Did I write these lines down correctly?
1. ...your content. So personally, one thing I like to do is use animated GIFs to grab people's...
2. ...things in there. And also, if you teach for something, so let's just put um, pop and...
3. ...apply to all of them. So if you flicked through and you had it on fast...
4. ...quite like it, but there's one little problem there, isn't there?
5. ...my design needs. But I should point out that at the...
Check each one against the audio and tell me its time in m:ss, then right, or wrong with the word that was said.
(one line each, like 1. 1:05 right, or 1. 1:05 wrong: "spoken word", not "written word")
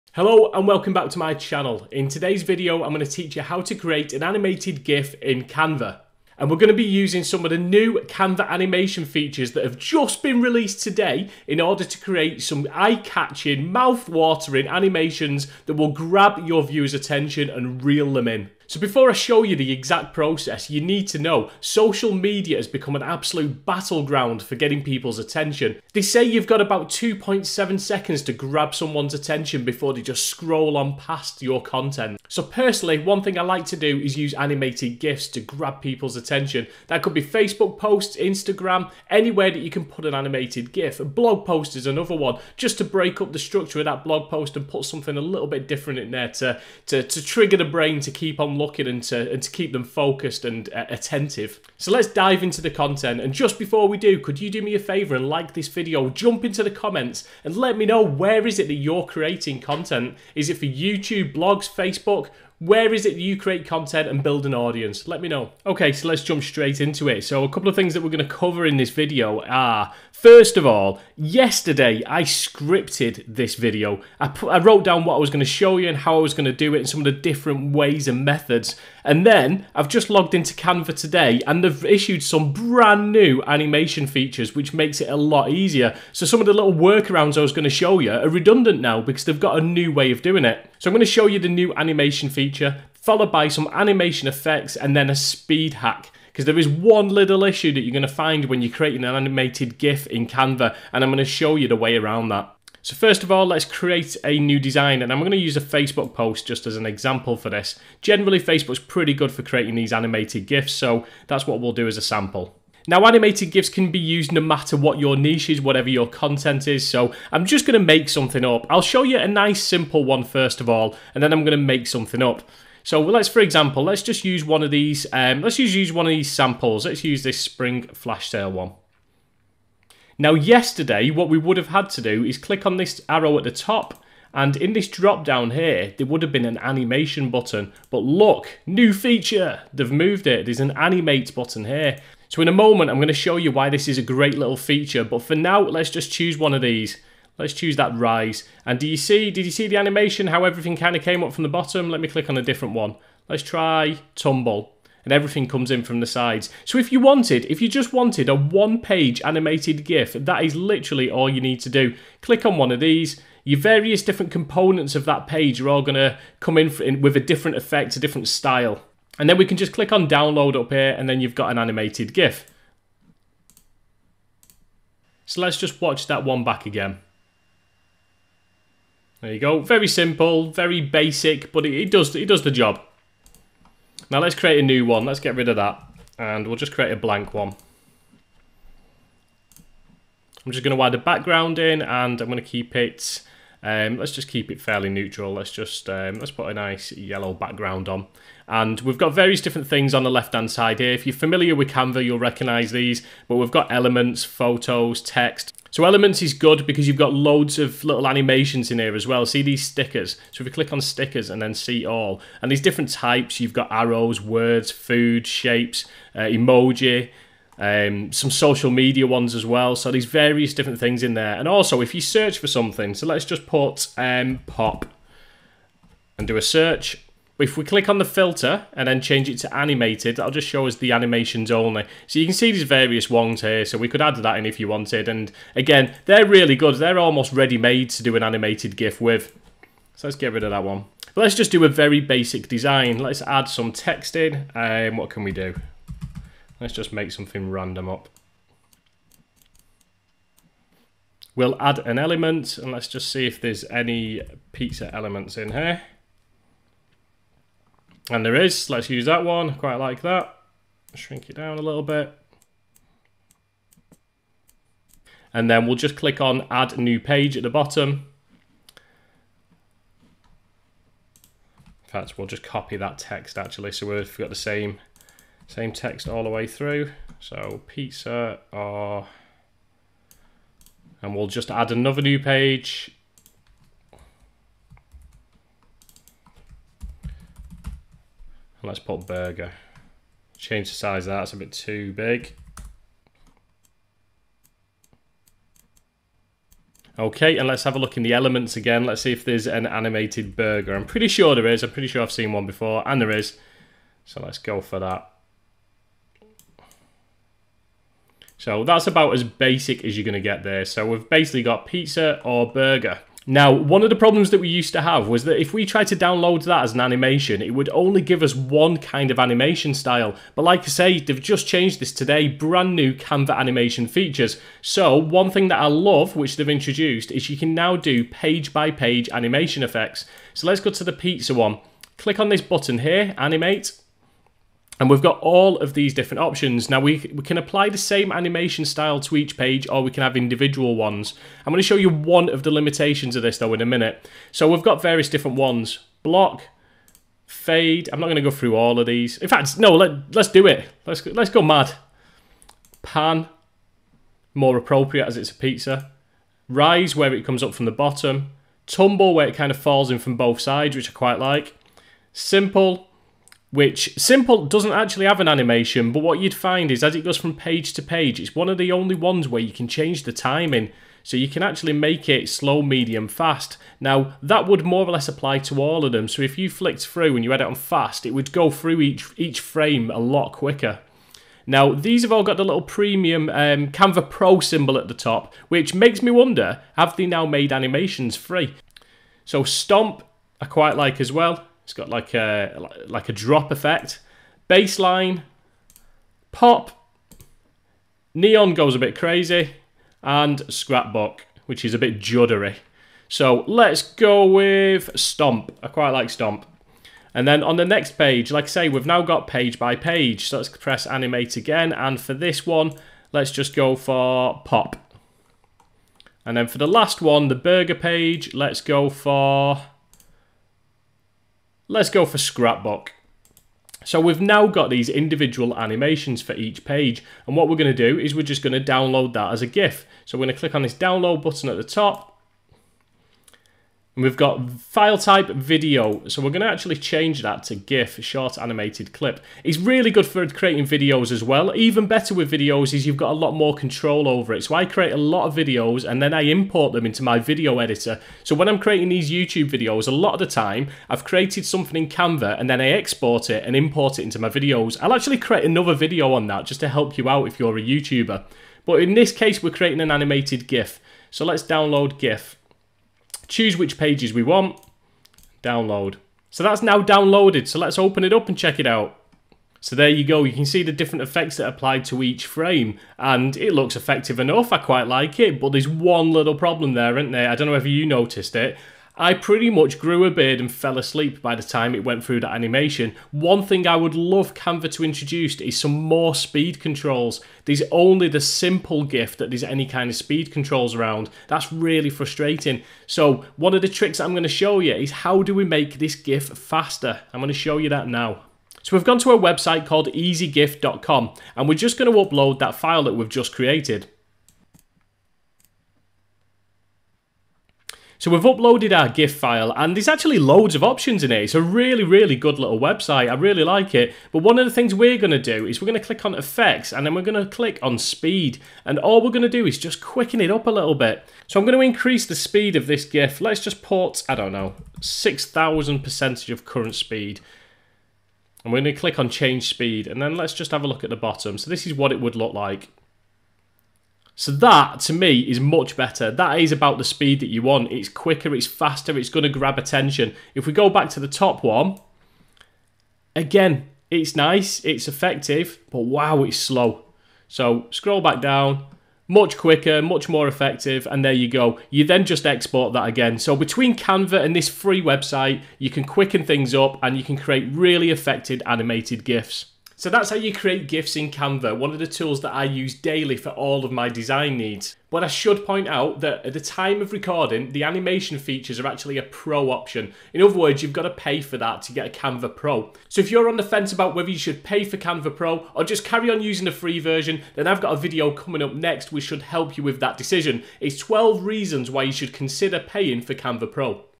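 1. 0:31 right
2. 3:40 wrong: "search", not "teach"
3. 6:15 right
4. 7:54 right
5. 9:23 right.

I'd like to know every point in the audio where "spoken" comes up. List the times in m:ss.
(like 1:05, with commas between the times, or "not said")
not said.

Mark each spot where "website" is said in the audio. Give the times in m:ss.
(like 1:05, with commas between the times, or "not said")
8:19, 8:32, 9:14.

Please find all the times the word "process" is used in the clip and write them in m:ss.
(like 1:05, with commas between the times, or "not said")
0:20.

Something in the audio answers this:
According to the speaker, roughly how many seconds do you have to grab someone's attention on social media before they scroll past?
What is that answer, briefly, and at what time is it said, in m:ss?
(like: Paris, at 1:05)
2.7 seconds, at 0:26.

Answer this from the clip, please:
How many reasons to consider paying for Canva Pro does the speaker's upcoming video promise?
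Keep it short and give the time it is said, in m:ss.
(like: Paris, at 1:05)
12, at 9:40.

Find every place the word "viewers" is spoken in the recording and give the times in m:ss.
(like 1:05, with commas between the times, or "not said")
0:16.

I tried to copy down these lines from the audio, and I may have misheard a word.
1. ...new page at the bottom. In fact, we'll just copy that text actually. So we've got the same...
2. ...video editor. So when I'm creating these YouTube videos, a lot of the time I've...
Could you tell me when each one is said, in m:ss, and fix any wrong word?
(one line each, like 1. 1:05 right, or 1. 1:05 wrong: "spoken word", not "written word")
1. 4:26 right
2. 7:27 right.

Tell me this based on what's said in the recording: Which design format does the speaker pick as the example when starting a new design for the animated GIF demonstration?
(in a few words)
Facebook post.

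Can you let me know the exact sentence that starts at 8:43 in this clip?
Let's just port, I don't know, 6000 percentage of current speed.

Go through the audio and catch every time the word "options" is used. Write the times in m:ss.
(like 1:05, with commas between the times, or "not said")
5:36, 8:30, 9:29.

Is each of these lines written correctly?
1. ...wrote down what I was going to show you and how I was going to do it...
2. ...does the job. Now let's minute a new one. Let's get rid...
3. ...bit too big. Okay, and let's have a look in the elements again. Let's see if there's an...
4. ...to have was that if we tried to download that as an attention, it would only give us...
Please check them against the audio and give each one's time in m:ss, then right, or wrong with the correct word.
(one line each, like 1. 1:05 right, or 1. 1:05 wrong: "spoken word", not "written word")
1. 1:14 right
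2. 3:02 wrong: "create", not "minute"
3. 4:51 right
4. 5:14 wrong: "animation", not "attention".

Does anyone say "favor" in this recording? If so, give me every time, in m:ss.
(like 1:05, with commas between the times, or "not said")
0:54.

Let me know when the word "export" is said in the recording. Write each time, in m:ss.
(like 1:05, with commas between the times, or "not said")
7:32, 9:12.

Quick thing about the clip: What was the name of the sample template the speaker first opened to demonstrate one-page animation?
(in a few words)
Spring flash sale.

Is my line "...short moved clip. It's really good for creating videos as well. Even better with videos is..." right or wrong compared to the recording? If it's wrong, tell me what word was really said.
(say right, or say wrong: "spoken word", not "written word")
wrong: "animated", not "moved".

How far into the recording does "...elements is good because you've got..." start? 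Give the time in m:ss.
3:25.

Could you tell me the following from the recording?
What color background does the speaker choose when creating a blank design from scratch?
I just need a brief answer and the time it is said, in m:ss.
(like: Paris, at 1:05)
Yellow, at 3:16.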